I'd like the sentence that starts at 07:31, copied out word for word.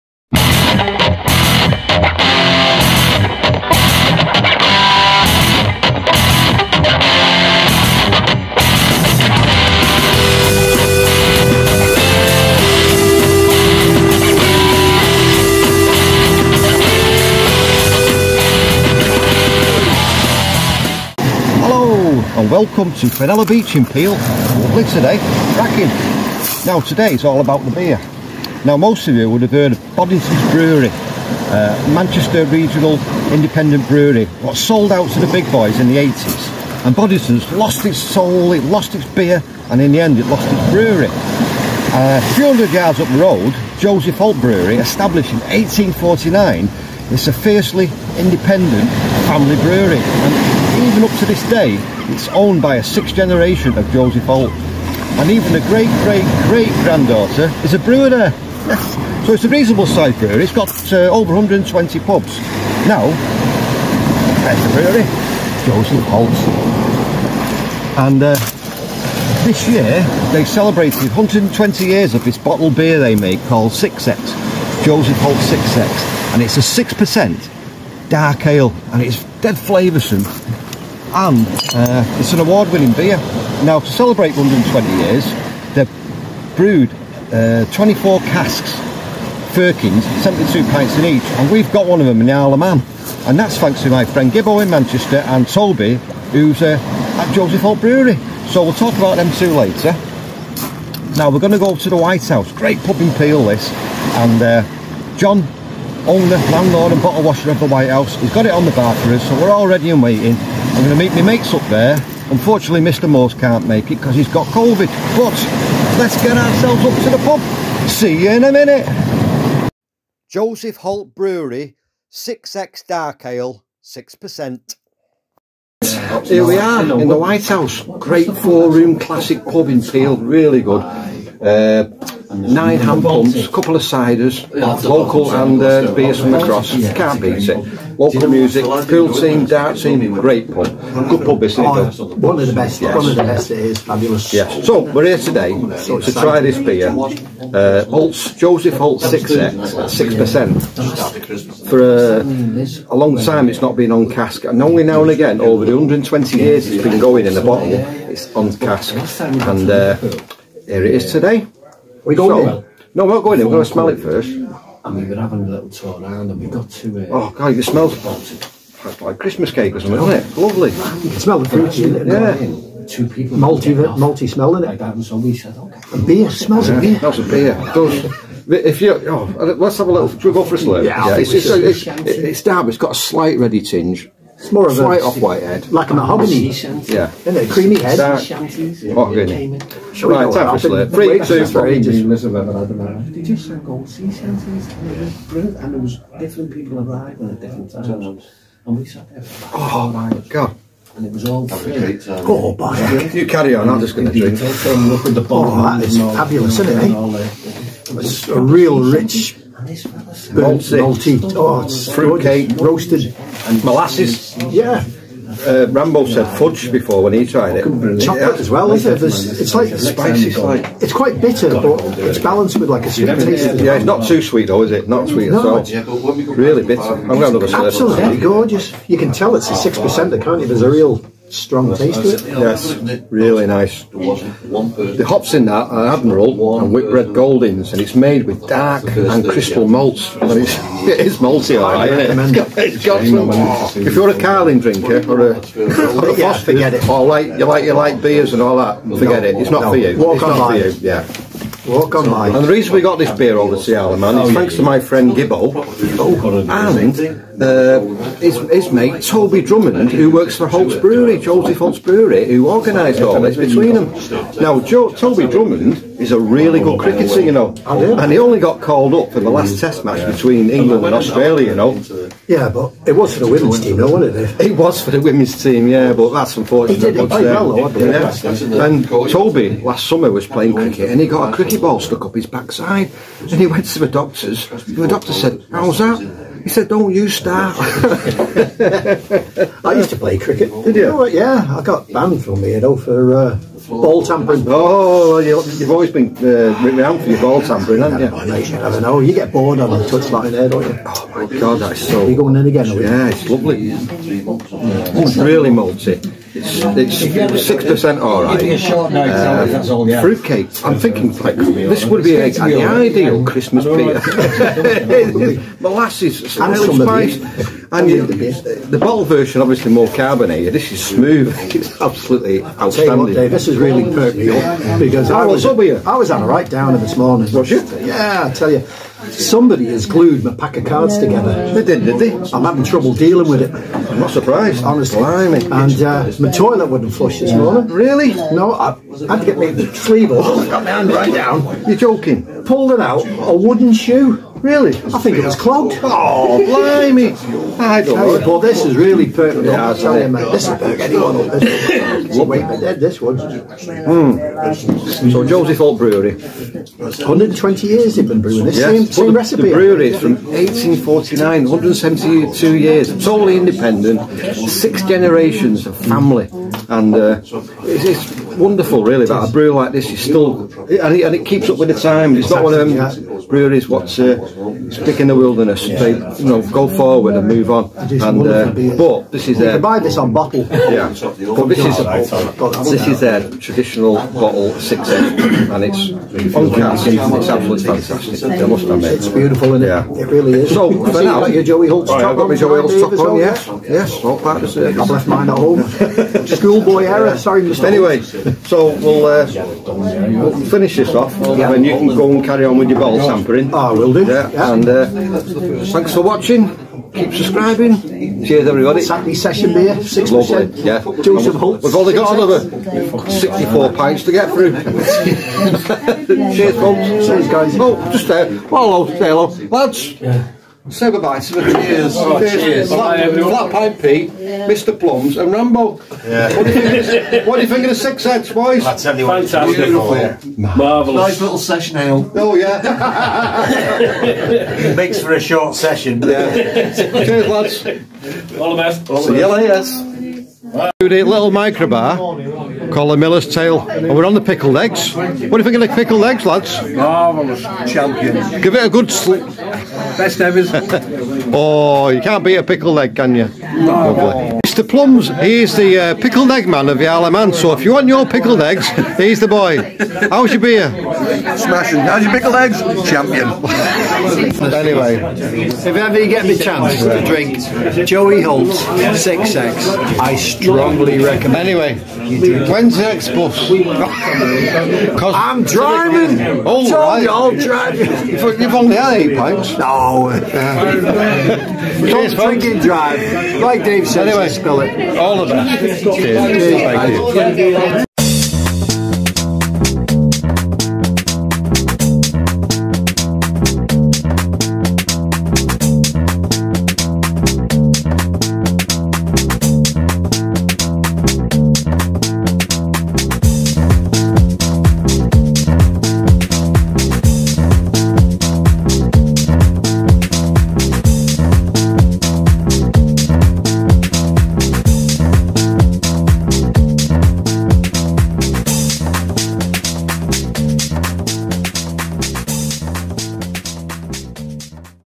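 oh, you can't beat a pickle leg, can you?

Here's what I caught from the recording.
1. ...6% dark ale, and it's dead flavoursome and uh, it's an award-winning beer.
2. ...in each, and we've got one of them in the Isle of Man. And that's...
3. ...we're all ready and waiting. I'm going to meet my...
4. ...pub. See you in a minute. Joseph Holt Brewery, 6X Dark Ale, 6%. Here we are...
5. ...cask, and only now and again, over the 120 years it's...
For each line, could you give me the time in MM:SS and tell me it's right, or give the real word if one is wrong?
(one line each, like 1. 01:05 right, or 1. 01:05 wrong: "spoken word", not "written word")
1. 01:16 right
2. 01:30 right
3. 01:49 right
4. 01:57 right
5. 02:34 right.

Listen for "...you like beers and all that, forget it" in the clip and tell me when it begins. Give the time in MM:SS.
04:07.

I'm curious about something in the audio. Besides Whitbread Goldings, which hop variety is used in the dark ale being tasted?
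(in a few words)
Admiral.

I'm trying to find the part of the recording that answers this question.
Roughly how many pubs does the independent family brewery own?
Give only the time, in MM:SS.
01:01.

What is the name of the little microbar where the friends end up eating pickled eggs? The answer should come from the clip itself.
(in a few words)
The Miller's Tail.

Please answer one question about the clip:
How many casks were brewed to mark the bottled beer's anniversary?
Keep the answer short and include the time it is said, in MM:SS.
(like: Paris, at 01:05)
24, at 01:27.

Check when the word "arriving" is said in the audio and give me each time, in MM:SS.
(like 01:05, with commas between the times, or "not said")
03:16.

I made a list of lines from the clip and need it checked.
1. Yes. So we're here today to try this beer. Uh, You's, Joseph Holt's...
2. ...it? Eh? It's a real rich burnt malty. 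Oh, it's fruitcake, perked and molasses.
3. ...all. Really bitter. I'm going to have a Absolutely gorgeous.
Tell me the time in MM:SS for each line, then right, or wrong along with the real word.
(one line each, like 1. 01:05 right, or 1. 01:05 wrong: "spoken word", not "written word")
1. 02:24 wrong: "Holt", not "You"
2. 03:26 wrong: "roasted", not "perked"
3. 03:45 right.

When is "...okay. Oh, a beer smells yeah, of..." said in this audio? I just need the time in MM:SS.
02:55.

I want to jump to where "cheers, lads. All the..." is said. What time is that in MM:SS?
07:16.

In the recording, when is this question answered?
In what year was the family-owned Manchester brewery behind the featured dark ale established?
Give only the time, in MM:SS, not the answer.
00:44.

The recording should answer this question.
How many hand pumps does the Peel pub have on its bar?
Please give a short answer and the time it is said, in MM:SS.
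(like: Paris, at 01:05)
Nine, at 02:12.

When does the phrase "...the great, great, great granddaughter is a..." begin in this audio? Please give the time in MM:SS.
00:55.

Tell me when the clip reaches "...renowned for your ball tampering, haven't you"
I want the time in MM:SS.
04:56.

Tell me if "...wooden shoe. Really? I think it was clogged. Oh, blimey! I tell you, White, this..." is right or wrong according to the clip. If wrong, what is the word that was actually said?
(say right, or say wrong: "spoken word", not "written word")
wrong: "Well", not "White".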